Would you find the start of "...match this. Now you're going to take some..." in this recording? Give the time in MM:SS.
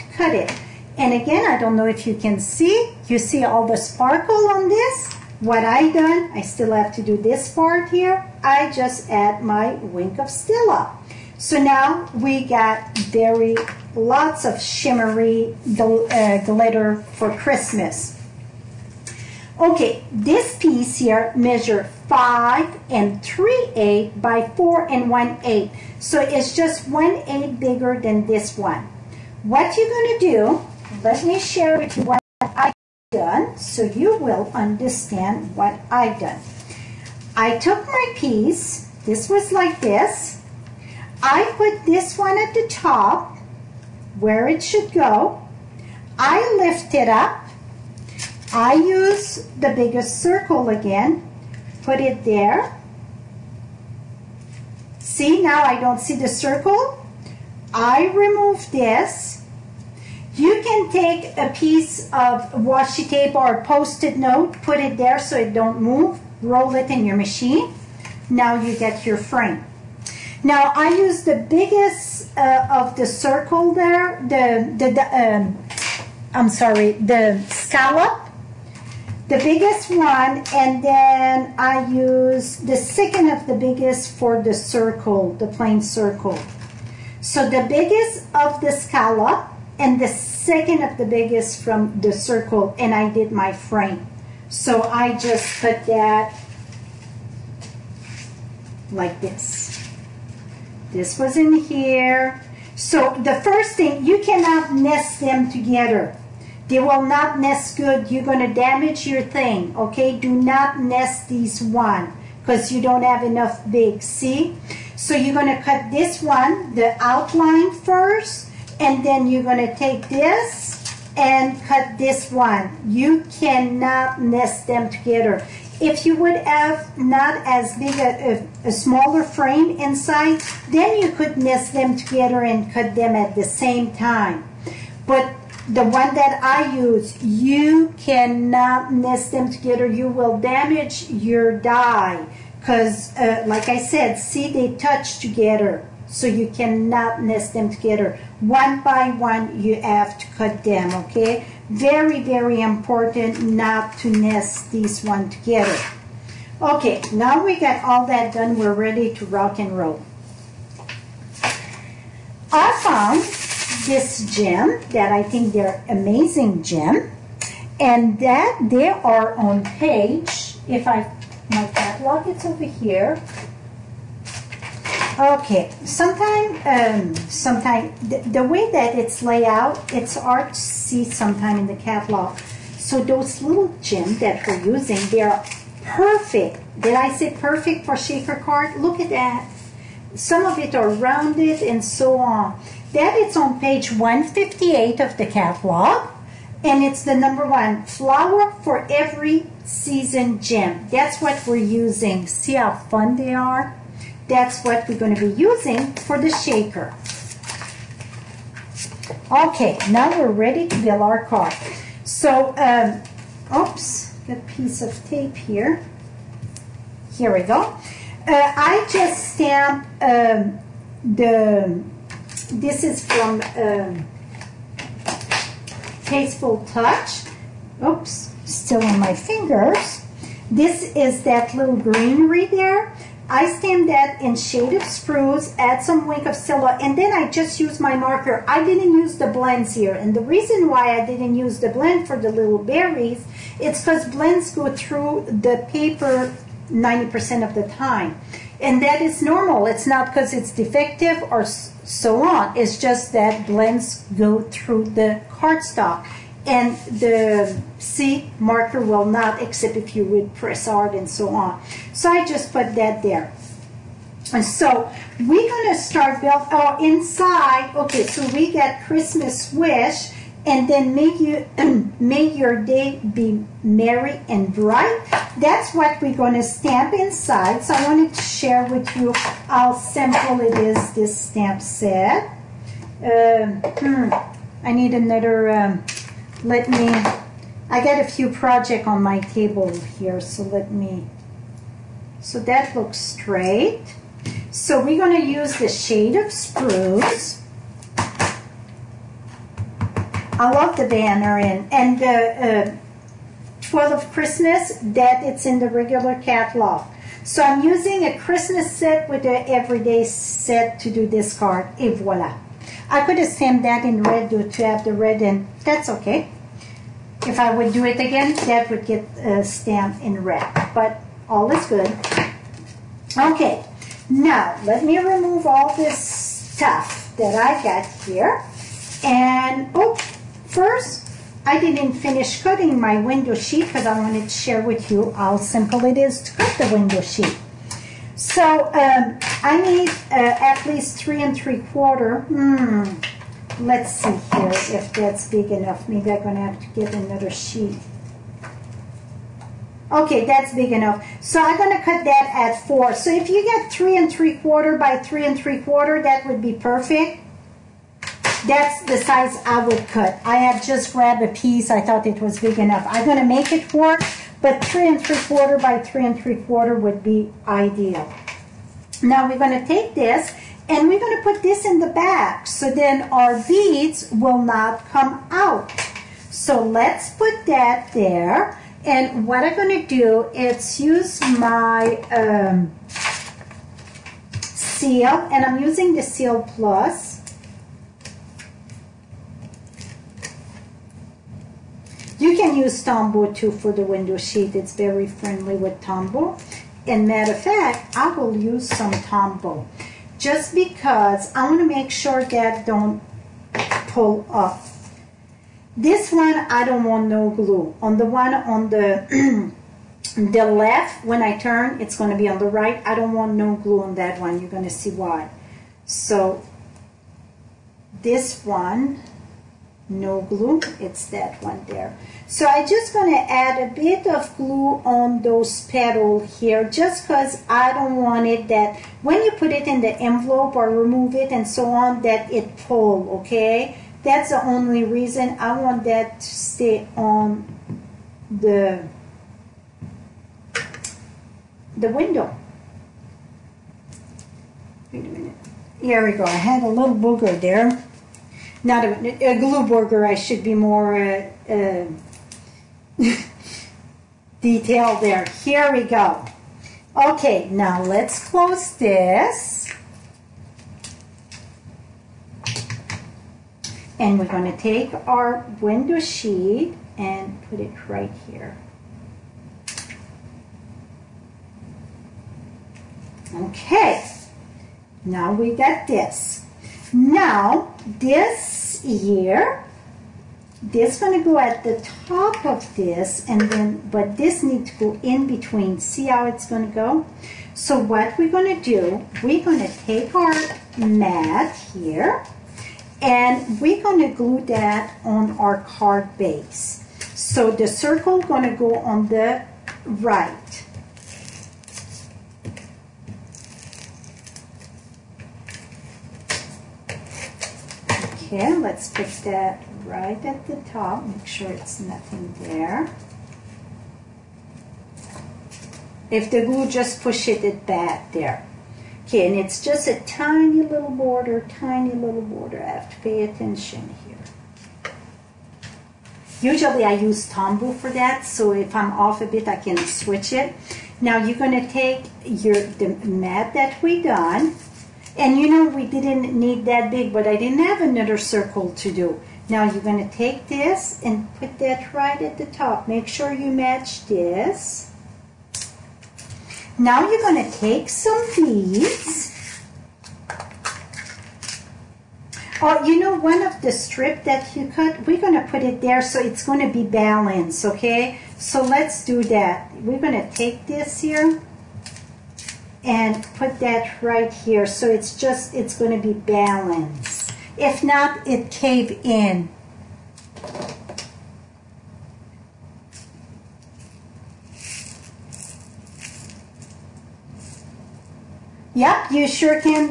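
09:03.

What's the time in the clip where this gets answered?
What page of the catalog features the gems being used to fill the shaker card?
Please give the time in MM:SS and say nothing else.
03:13.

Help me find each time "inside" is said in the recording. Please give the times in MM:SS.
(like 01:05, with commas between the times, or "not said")
02:09, 04:26, 04:36.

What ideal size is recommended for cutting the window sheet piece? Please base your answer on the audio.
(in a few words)
3 3/4 by 3 3/4.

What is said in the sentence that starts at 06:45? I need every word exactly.
This one, I don't want no glue.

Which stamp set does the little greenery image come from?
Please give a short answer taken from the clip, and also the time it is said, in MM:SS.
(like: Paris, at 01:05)
Tasteful Touch, at 03:46.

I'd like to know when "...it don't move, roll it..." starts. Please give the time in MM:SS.
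01:05.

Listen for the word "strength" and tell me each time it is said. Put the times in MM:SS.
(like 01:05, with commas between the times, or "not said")
not said.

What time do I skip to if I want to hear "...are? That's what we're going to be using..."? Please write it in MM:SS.
03:23.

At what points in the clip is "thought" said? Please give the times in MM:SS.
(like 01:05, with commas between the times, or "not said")
06:01.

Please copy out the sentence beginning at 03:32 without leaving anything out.
So, um, oops, a piece of tape here.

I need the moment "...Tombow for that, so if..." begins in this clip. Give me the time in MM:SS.
08:47.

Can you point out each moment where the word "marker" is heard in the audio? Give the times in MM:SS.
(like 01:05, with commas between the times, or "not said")
03:57, 04:18.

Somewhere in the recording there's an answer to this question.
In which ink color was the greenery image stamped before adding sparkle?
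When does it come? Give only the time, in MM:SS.
03:54.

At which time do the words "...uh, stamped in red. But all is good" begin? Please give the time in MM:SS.
05:19.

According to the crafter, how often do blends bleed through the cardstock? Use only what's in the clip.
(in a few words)
90%.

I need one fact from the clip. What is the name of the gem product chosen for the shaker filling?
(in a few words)
Flower for every season gem.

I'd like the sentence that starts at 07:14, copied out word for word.
That's the only reason I want that to stay on the, the window.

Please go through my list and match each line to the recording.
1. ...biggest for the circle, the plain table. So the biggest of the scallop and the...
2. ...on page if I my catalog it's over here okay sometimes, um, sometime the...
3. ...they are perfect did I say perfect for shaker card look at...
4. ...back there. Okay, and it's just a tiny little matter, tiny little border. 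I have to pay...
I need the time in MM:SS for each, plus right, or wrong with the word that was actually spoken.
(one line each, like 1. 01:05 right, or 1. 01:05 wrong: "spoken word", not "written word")
1. 01:23 wrong: "circle", not "table"
2. 02:49 right
3. 03:05 right
4. 08:37 wrong: "border", not "matter".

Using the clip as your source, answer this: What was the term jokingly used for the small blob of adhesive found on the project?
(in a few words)
Gluburger.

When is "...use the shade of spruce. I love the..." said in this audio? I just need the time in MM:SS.
04:55.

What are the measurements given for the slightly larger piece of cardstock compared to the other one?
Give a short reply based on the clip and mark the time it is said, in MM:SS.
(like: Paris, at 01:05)
5 3/8 by 4 1/8, at 00:22.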